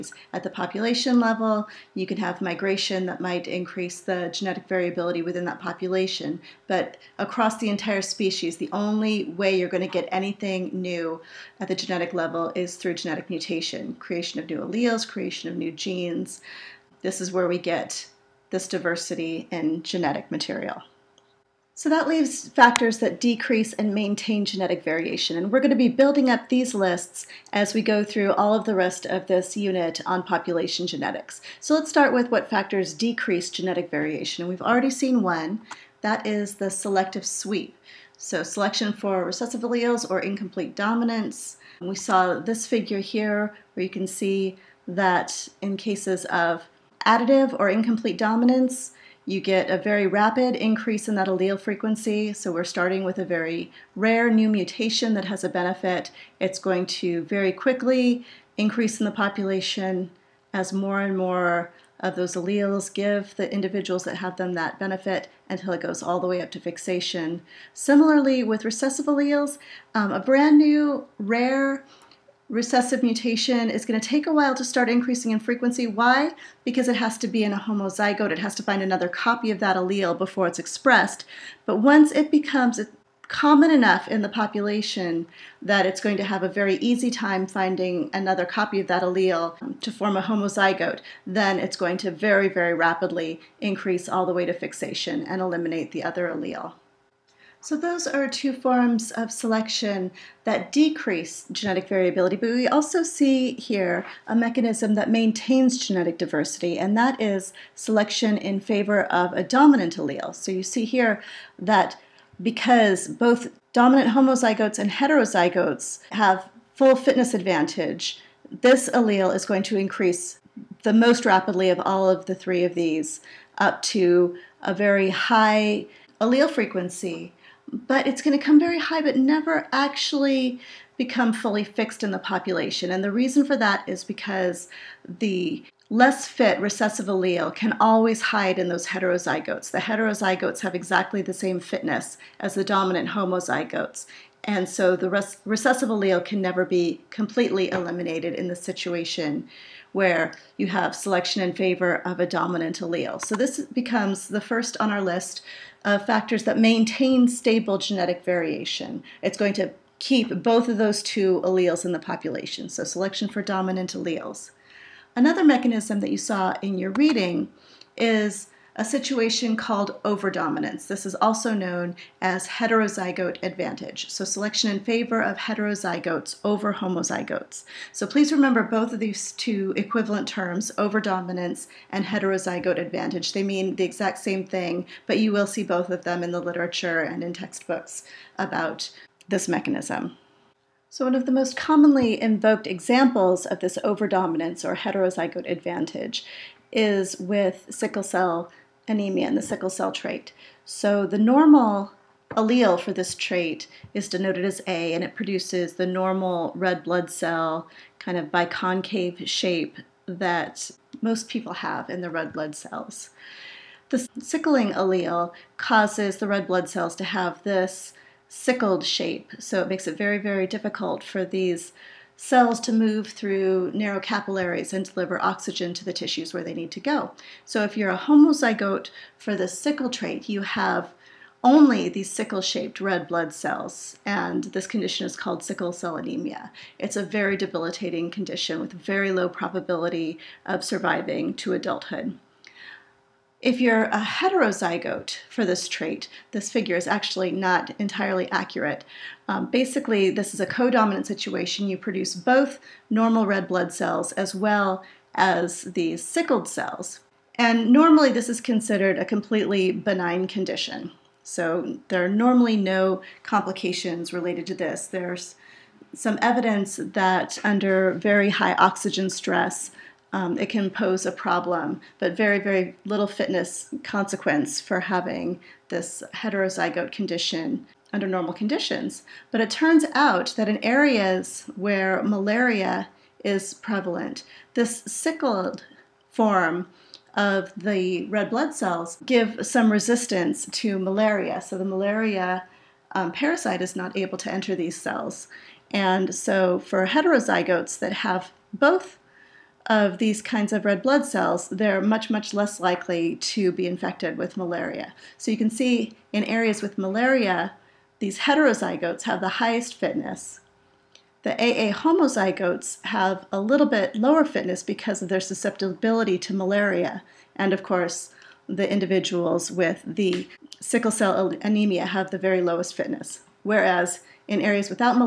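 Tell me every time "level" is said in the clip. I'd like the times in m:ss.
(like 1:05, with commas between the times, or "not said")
0:01, 0:12.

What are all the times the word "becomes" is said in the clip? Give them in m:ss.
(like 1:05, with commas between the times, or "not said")
1:22, 2:10, 2:33.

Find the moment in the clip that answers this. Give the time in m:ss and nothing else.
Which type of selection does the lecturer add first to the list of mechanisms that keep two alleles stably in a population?
2:42.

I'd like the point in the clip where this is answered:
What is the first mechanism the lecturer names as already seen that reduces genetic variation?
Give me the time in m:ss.
0:36.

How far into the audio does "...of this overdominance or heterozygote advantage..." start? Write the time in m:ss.
3:13.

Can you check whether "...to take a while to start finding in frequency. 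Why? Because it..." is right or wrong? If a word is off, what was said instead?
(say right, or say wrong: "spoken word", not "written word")
wrong: "increasing", not "finding".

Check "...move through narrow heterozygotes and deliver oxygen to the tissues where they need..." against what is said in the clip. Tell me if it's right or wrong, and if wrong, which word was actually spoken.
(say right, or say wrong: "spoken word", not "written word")
wrong: "capillaries", not "heterozygotes".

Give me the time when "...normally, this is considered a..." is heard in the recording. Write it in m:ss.
4:17.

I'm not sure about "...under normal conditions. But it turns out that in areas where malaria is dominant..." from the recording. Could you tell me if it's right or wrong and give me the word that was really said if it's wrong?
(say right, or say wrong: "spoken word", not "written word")
wrong: "prevalent", not "dominant".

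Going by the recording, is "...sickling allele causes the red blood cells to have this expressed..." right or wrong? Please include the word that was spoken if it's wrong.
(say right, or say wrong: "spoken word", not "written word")
wrong: "sickled", not "expressed".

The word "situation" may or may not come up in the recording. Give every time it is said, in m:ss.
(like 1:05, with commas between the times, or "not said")
2:28, 2:48, 4:11.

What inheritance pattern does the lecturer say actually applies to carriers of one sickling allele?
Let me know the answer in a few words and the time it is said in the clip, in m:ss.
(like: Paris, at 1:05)
codominant, at 4:10.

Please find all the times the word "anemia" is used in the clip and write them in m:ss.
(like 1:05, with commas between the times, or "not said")
3:18, 3:55, 5:21.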